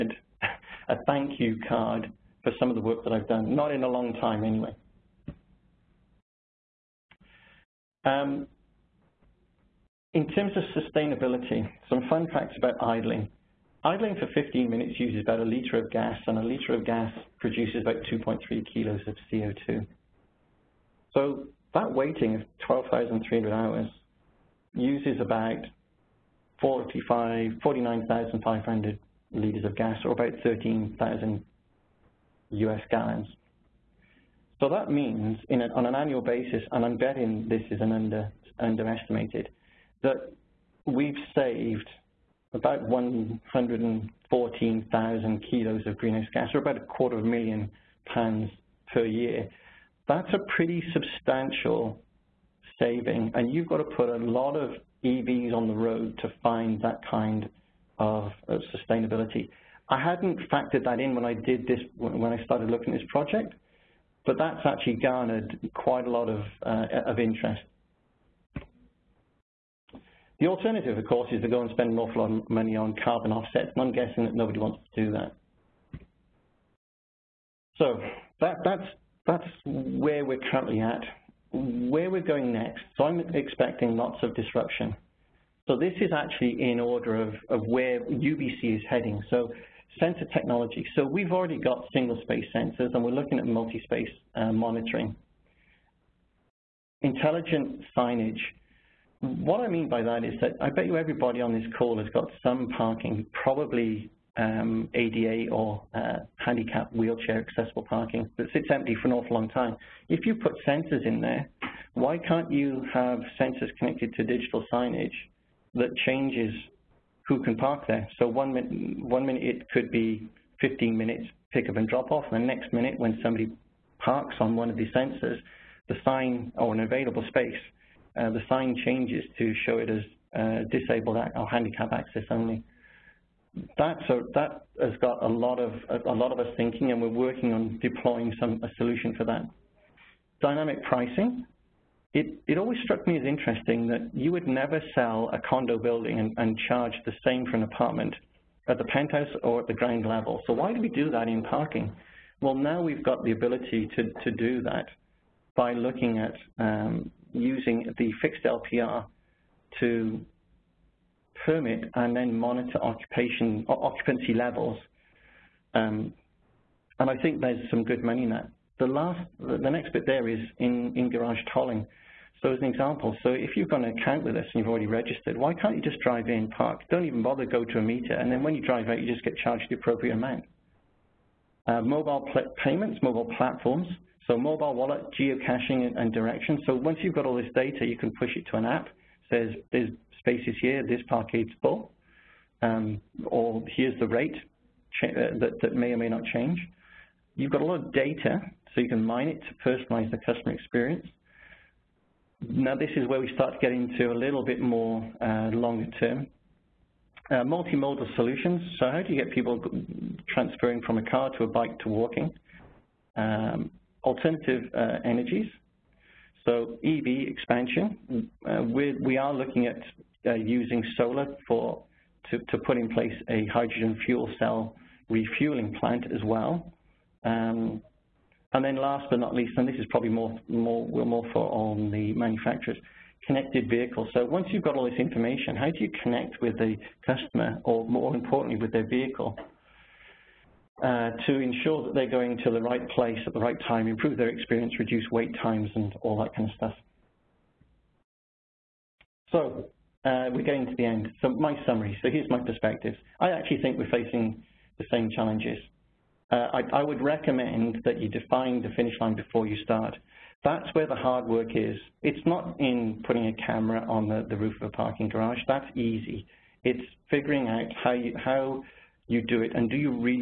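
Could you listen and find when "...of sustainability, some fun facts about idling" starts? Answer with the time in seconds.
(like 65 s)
10 s.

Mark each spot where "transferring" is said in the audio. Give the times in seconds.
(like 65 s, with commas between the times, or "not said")
210 s.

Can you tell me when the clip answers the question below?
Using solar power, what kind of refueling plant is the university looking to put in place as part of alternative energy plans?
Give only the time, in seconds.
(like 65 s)
223 s.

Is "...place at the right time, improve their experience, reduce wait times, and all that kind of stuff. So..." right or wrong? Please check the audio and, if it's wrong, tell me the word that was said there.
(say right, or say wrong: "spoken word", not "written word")
right.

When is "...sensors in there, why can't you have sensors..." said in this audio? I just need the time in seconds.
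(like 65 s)
110 s.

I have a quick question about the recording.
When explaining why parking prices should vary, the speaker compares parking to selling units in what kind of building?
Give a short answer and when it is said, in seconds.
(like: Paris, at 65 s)
condo building, at 145 s.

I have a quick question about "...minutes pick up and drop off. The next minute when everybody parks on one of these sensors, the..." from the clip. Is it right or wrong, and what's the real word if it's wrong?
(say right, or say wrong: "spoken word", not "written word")
wrong: "somebody", not "everybody".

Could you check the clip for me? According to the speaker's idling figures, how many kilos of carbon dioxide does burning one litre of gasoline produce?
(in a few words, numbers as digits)
2.3 kilos.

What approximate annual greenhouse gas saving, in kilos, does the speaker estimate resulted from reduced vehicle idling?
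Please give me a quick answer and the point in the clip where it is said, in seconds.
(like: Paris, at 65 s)
114,000 kilos, at 42 s.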